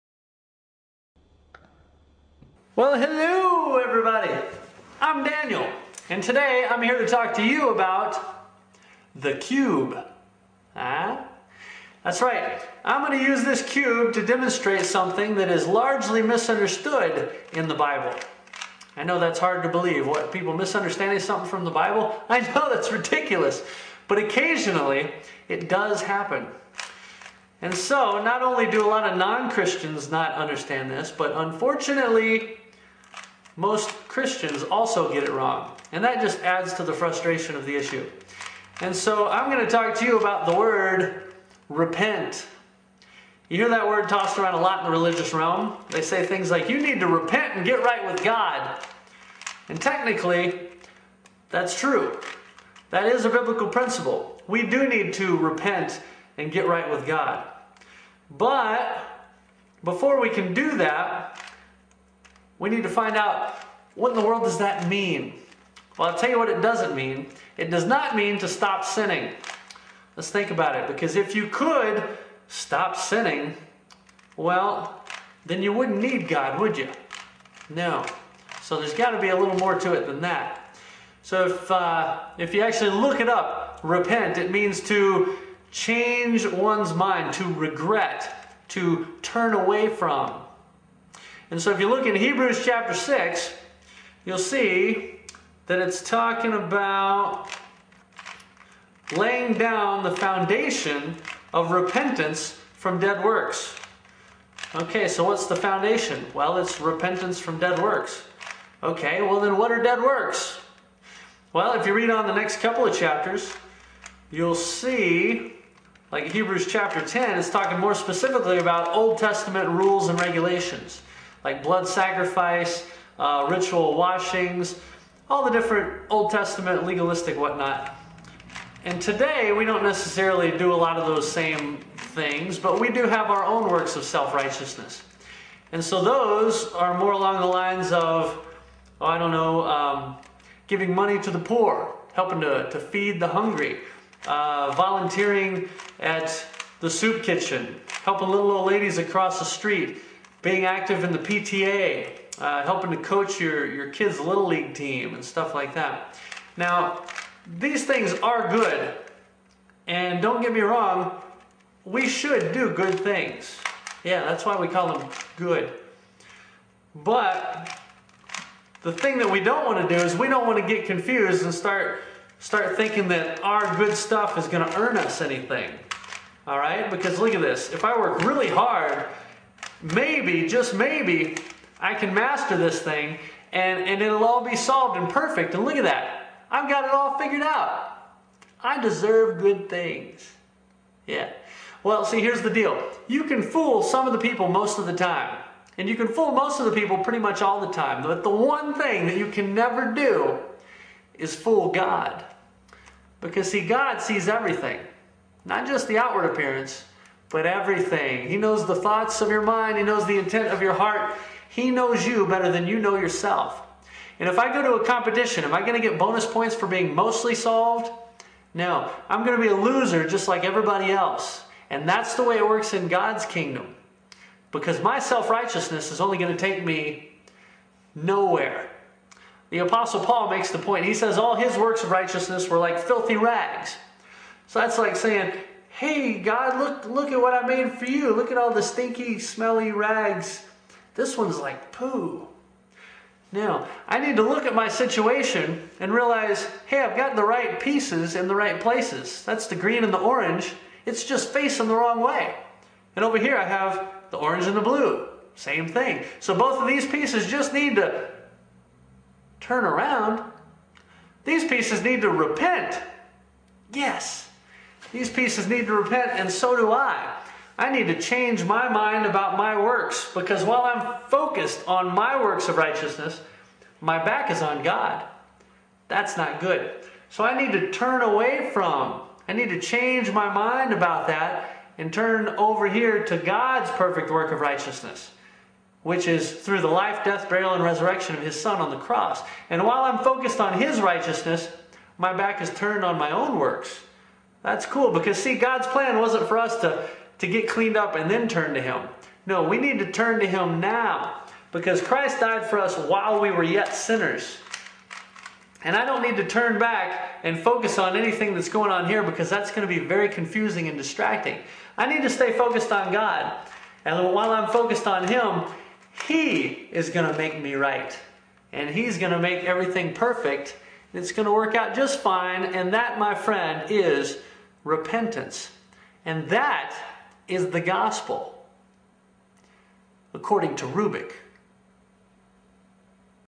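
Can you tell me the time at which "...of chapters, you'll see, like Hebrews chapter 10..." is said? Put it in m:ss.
1:52.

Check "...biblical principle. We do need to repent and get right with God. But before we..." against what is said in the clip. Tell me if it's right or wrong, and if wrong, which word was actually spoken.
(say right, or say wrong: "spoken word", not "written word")
right.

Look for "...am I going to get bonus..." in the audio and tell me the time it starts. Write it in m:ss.
3:35.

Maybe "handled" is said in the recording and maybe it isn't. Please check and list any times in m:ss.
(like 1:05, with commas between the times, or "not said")
not said.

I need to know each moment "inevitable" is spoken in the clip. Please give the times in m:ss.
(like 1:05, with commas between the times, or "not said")
not said.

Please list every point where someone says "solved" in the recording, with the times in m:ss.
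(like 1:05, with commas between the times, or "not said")
3:04, 3:37.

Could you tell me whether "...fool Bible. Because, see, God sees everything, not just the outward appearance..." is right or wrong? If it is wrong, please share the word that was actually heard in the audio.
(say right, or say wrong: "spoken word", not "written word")
wrong: "God", not "Bible".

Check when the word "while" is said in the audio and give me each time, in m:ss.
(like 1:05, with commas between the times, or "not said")
4:30, 4:49, 5:02, 5:14.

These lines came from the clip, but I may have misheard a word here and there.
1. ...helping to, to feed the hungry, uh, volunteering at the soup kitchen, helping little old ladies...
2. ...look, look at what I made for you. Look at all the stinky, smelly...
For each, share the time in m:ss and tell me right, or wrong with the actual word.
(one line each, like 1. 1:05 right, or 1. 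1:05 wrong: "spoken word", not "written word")
1. 2:22 right
2. 3:56 right.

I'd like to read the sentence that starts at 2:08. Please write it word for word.
And today, we don't necessarily do a lot of those same things, but we do have our own works of self righteousness.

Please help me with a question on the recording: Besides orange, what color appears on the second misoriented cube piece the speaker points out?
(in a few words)
Blue.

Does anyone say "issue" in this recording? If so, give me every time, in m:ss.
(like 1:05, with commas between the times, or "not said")
0:37.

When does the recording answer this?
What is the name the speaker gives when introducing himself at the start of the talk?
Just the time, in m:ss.
0:05.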